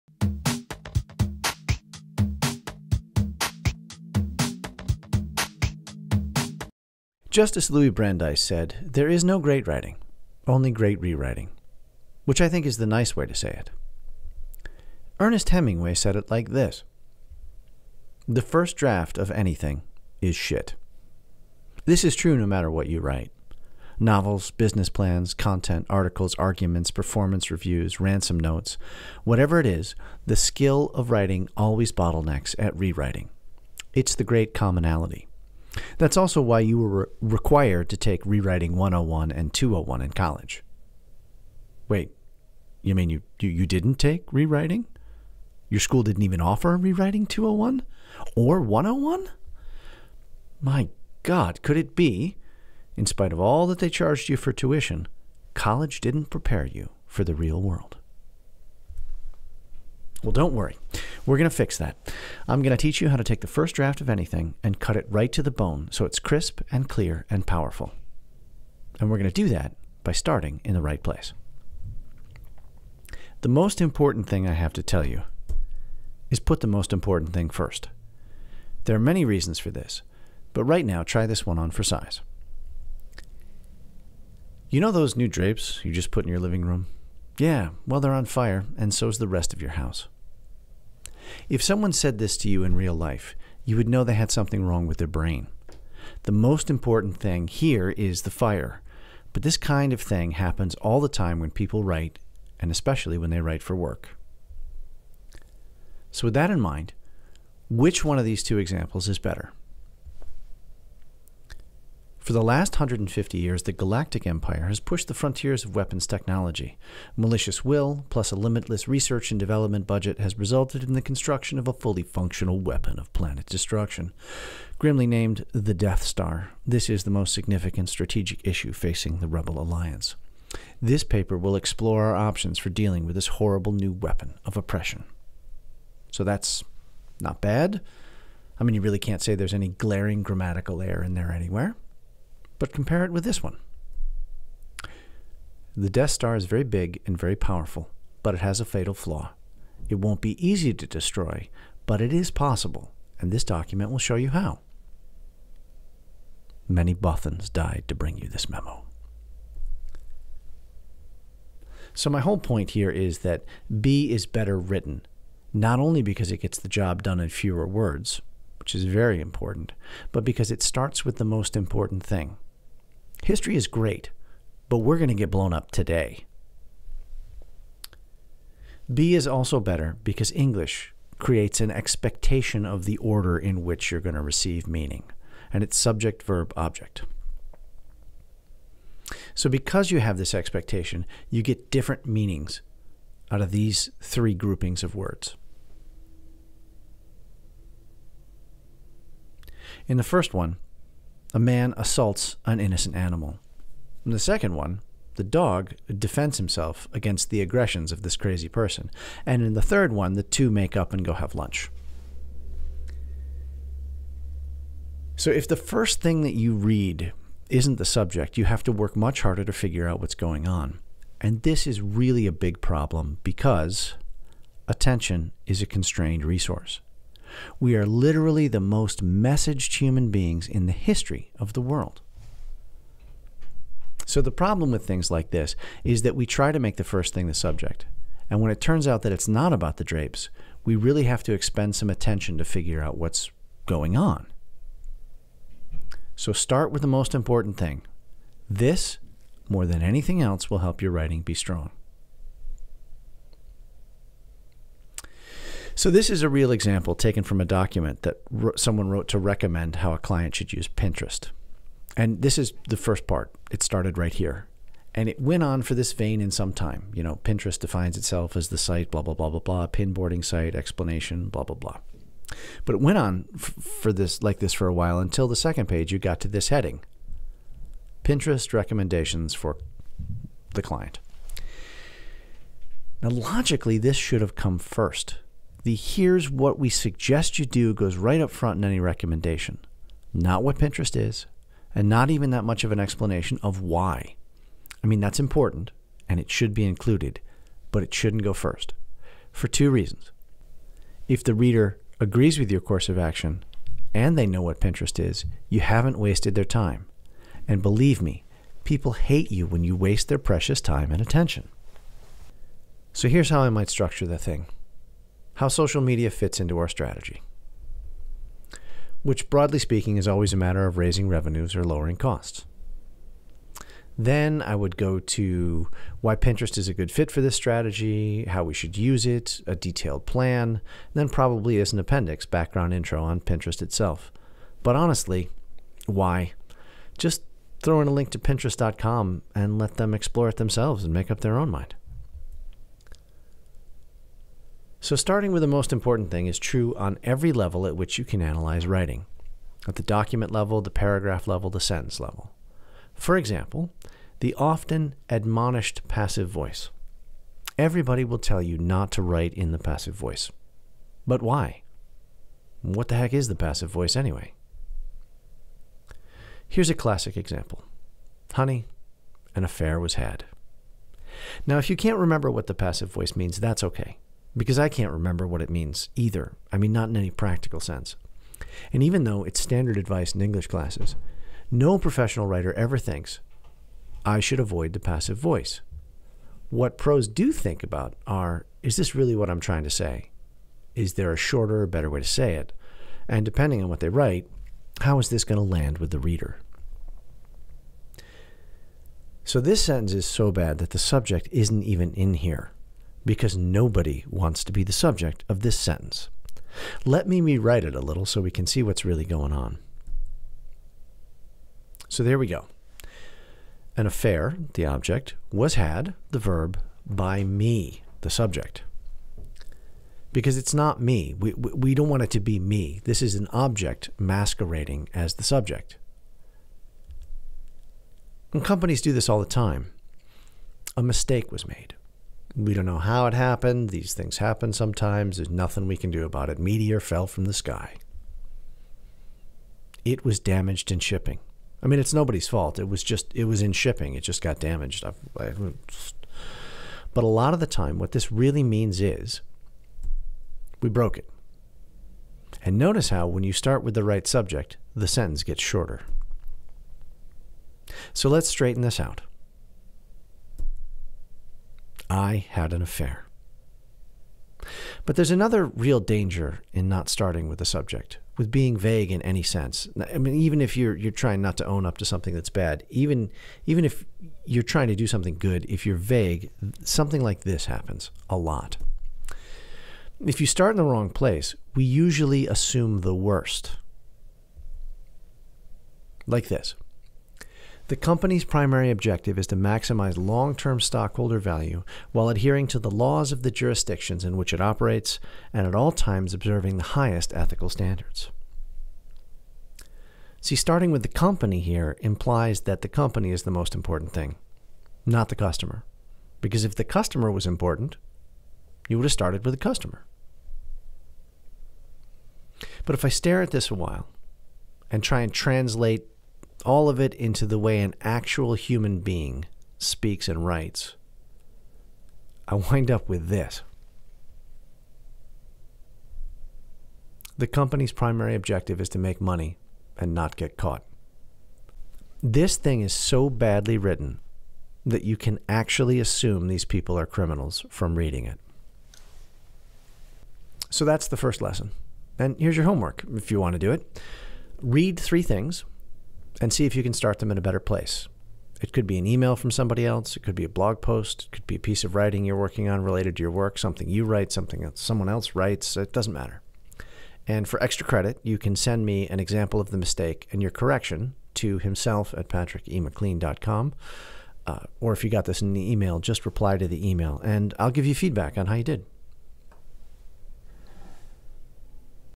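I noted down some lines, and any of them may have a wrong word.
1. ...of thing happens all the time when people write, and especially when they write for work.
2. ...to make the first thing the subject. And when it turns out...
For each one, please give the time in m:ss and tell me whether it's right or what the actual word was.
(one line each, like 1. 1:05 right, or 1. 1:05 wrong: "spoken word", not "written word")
1. 1:39 right
2. 3:56 right.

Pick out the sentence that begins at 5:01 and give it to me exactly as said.
If the reader agrees with your course of action and they know what Pinterest is, you haven't wasted their time.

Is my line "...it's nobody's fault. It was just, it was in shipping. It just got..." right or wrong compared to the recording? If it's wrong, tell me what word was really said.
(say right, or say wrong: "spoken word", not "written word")
right.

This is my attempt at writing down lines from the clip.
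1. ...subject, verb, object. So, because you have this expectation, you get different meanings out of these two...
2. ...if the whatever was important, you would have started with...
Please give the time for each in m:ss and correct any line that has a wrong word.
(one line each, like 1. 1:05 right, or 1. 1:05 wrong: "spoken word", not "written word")
1. 3:05 wrong: "three", not "two"
2. 8:26 wrong: "customer", not "whatever".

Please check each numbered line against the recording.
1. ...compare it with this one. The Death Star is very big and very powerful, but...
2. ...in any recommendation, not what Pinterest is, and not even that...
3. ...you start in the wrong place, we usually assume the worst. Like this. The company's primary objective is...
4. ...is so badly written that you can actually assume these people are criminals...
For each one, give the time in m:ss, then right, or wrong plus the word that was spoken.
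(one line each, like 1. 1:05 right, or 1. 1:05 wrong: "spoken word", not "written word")
1. 2:22 right
2. 4:48 right
3. 8:00 right
4. 8:52 right.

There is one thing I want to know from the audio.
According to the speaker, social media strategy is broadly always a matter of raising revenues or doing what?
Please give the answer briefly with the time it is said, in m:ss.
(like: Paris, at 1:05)
lowering costs, at 5:21.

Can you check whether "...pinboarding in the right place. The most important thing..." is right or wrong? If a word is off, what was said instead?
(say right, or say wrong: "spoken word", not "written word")
wrong: "starting", not "pinboarding".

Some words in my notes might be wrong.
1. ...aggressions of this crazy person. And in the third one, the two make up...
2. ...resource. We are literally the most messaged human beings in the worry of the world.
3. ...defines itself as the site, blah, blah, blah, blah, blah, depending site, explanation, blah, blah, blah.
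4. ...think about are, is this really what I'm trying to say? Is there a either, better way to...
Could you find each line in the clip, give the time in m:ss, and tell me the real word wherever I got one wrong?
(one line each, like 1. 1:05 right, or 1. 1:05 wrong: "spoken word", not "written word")
1. 3:27 right
2. 3:46 wrong: "history", not "worry"
3. 4:27 wrong: "pinboarding", not "depending"
4. 6:27 wrong: "shorter", not "either".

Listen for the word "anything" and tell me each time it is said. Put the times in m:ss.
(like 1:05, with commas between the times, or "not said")
0:19, 1:04, 4:09.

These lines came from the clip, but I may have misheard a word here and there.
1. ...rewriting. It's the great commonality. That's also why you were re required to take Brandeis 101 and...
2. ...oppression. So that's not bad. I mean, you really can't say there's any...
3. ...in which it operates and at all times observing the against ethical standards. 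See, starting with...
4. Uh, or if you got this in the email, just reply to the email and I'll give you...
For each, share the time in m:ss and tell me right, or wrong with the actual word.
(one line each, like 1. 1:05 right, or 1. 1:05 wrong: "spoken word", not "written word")
1. 0:32 wrong: "Rewriting", not "Brandeis"
2. 2:14 right
3. 8:14 wrong: "highest", not "against"
4. 9:24 right.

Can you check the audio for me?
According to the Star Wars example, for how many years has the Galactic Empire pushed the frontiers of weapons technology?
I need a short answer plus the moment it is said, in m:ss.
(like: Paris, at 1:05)
150, at 1:52.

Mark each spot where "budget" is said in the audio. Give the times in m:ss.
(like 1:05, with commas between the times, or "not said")
1:59.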